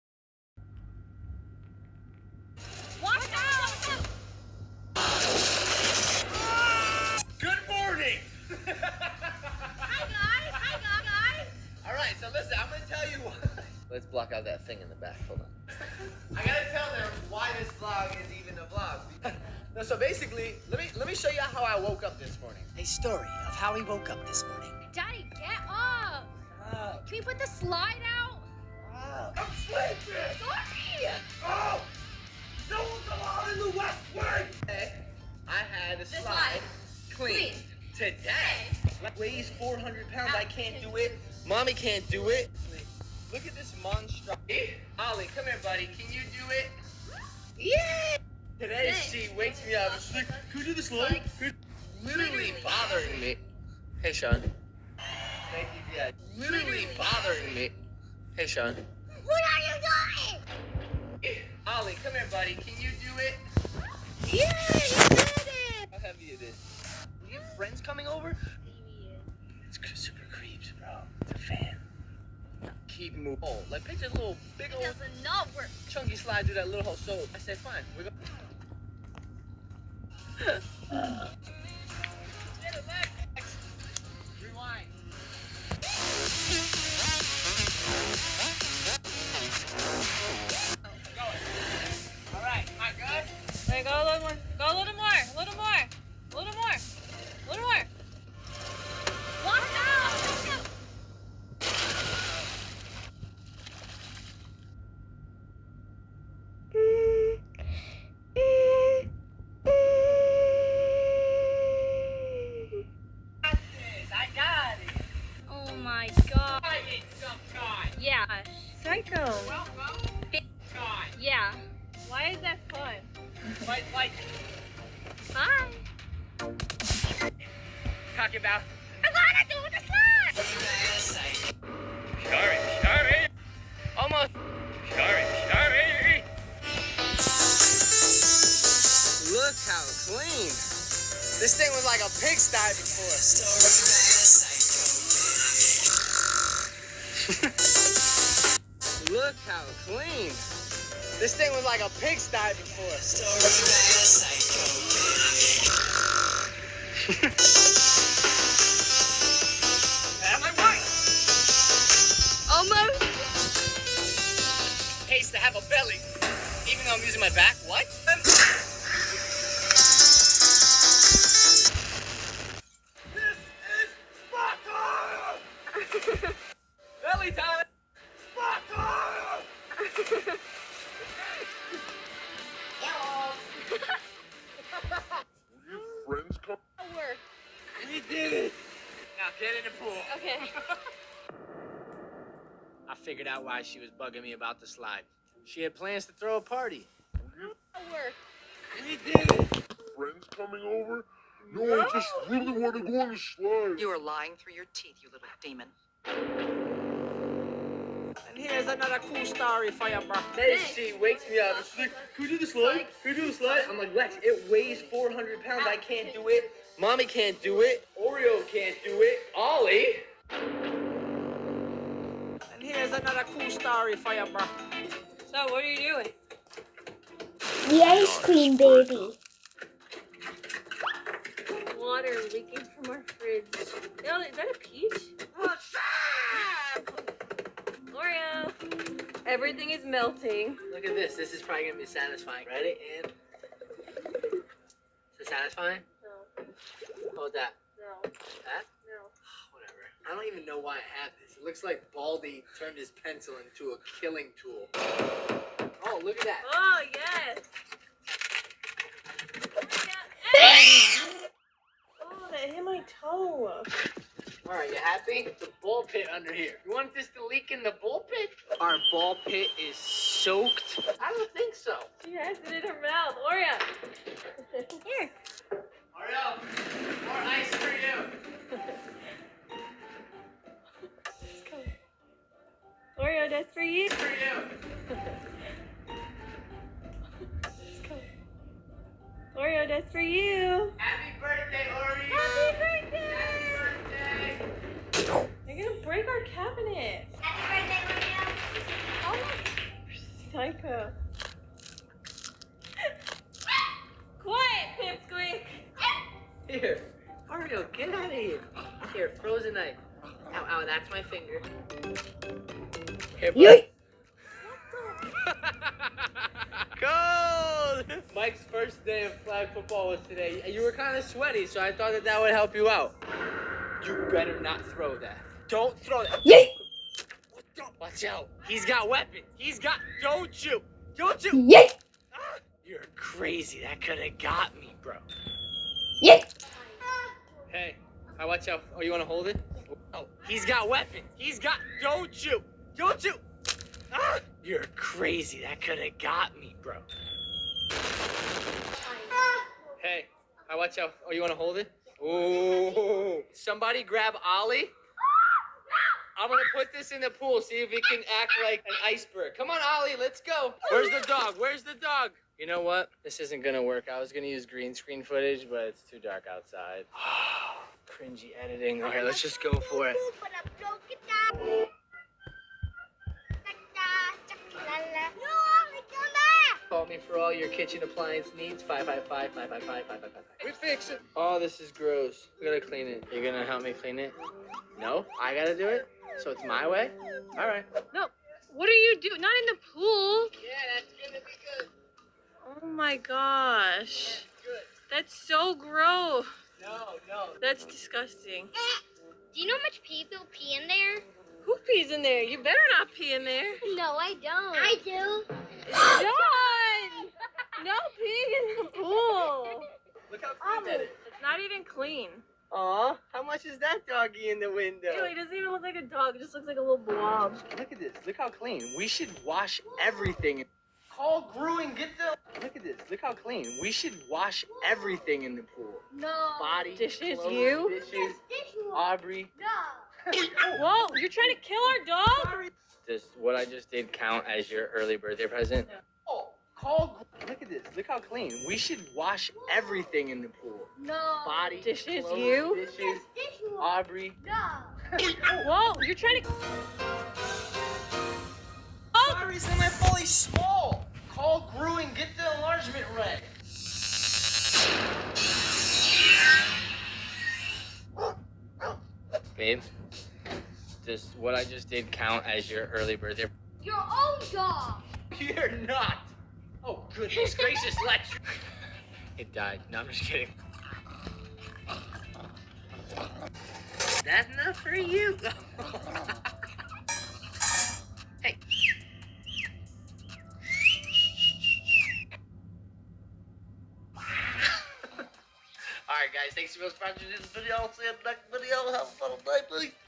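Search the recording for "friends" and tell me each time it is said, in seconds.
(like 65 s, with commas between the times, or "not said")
67 s, 199 s.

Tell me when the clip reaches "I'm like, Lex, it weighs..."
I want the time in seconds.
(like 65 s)
213 s.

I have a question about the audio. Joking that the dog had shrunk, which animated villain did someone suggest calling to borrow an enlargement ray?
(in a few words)
Gru.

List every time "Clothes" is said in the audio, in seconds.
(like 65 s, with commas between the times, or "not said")
427 s, 442 s.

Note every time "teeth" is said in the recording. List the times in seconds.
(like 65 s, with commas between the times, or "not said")
204 s.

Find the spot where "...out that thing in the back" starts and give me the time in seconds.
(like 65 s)
14 s.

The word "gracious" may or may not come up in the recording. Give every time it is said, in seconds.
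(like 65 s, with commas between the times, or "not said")
467 s.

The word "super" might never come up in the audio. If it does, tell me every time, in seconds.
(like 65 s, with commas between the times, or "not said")
70 s.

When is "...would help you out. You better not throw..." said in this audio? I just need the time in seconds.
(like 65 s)
322 s.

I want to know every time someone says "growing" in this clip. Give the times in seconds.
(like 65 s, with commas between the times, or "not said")
421 s.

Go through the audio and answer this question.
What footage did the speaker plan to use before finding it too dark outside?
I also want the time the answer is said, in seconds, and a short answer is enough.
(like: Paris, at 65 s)
green screen footage, at 364 s.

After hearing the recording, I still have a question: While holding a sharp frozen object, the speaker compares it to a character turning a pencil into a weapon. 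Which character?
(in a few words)
Baldy.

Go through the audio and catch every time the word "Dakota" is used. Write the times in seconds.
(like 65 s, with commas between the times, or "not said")
not said.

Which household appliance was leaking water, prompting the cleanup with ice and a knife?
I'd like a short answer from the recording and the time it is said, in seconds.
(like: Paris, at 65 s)
fridge, at 233 s.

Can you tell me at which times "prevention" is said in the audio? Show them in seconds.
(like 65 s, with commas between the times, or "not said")
not said.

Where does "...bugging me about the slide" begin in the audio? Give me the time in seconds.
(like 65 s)
193 s.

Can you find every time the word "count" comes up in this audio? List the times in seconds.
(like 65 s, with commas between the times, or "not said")
433 s, 461 s.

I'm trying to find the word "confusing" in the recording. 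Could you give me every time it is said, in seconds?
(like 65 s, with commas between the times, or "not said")
not said.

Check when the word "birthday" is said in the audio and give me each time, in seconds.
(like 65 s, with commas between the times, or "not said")
434 s, 462 s.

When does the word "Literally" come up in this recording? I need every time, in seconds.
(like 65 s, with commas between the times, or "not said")
52 s, 56 s.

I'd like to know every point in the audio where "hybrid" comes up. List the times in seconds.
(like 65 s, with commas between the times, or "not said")
not said.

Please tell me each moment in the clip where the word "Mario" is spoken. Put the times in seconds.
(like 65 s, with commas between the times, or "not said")
238 s, 307 s.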